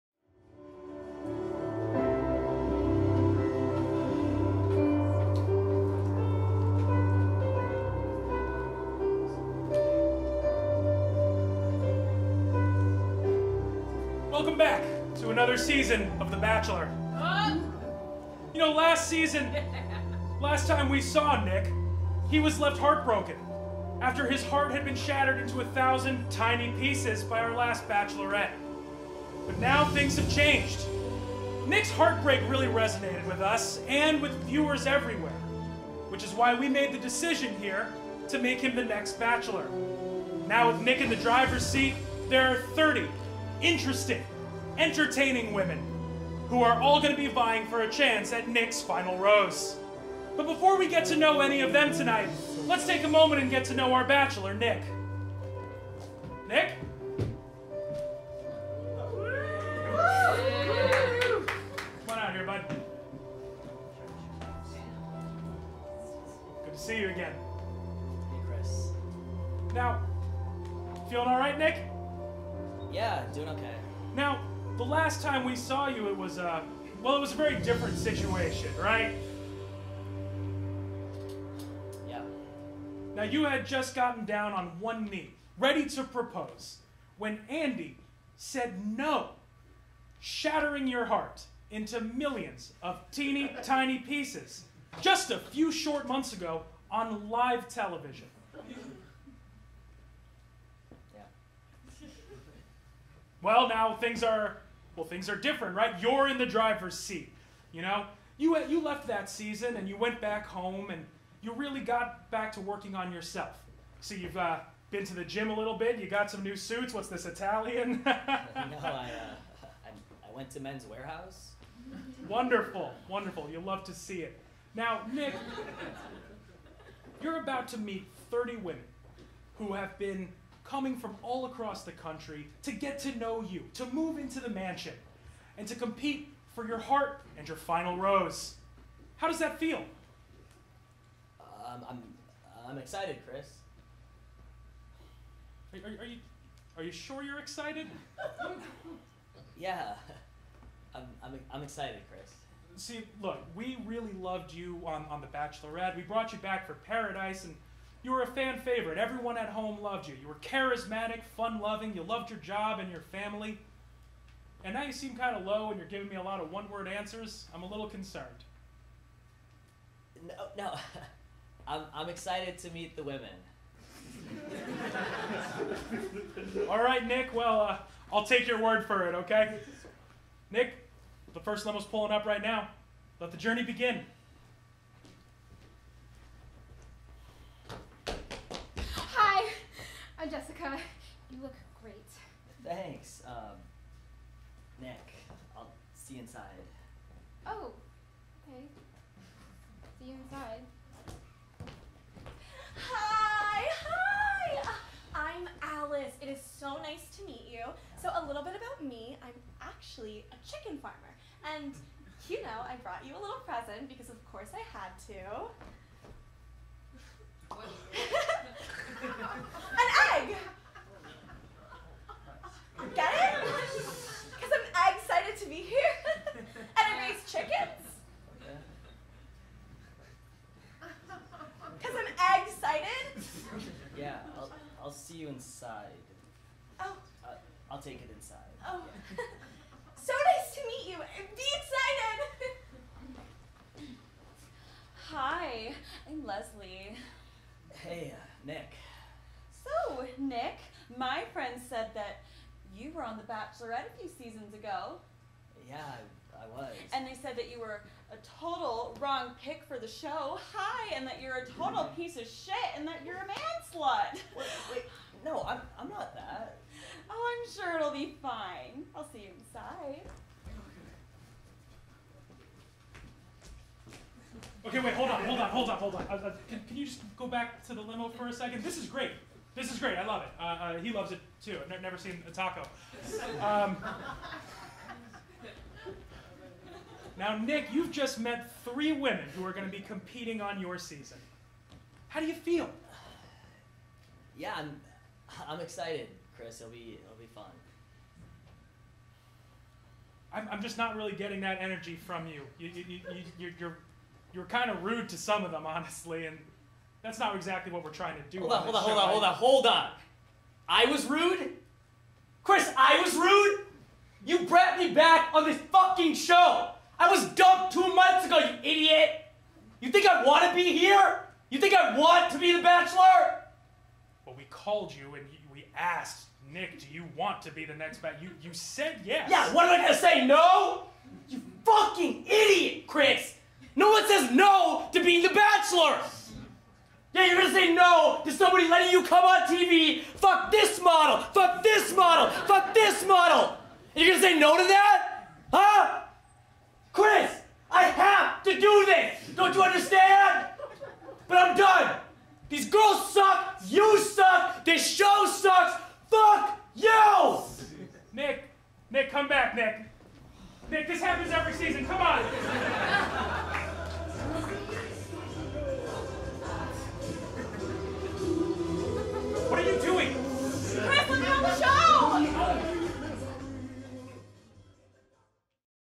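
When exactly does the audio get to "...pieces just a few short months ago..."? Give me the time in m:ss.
1:33.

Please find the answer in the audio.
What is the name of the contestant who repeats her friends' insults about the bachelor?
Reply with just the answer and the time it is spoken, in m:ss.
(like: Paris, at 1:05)
Leslie, at 4:06.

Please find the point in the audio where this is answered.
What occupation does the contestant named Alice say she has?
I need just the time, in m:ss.
3:30.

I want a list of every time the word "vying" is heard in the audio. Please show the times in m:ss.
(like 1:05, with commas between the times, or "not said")
0:47.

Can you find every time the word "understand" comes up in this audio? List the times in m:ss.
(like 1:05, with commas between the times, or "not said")
5:49.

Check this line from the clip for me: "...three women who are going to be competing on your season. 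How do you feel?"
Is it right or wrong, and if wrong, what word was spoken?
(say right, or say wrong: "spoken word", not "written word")
right.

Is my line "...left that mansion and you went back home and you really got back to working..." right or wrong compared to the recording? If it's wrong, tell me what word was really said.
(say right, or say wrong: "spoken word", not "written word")
wrong: "season", not "mansion".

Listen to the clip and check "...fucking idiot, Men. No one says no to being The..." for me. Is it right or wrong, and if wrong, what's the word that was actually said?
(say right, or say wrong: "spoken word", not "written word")
wrong: "Chris", not "Men".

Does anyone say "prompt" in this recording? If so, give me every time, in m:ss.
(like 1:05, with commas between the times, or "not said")
not said.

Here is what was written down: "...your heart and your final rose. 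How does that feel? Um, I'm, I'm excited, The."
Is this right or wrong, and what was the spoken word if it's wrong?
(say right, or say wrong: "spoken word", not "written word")
wrong: "Chris", not "The".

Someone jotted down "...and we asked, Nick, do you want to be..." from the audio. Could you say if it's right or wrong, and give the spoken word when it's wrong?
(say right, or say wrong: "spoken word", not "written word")
right.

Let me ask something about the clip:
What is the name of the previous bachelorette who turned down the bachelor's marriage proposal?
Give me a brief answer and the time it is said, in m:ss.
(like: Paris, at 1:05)
Andy, at 1:27.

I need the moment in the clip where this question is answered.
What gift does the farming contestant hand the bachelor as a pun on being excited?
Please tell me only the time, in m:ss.
3:39.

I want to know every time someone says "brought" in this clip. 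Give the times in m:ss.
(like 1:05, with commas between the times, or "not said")
2:36, 3:32, 5:14.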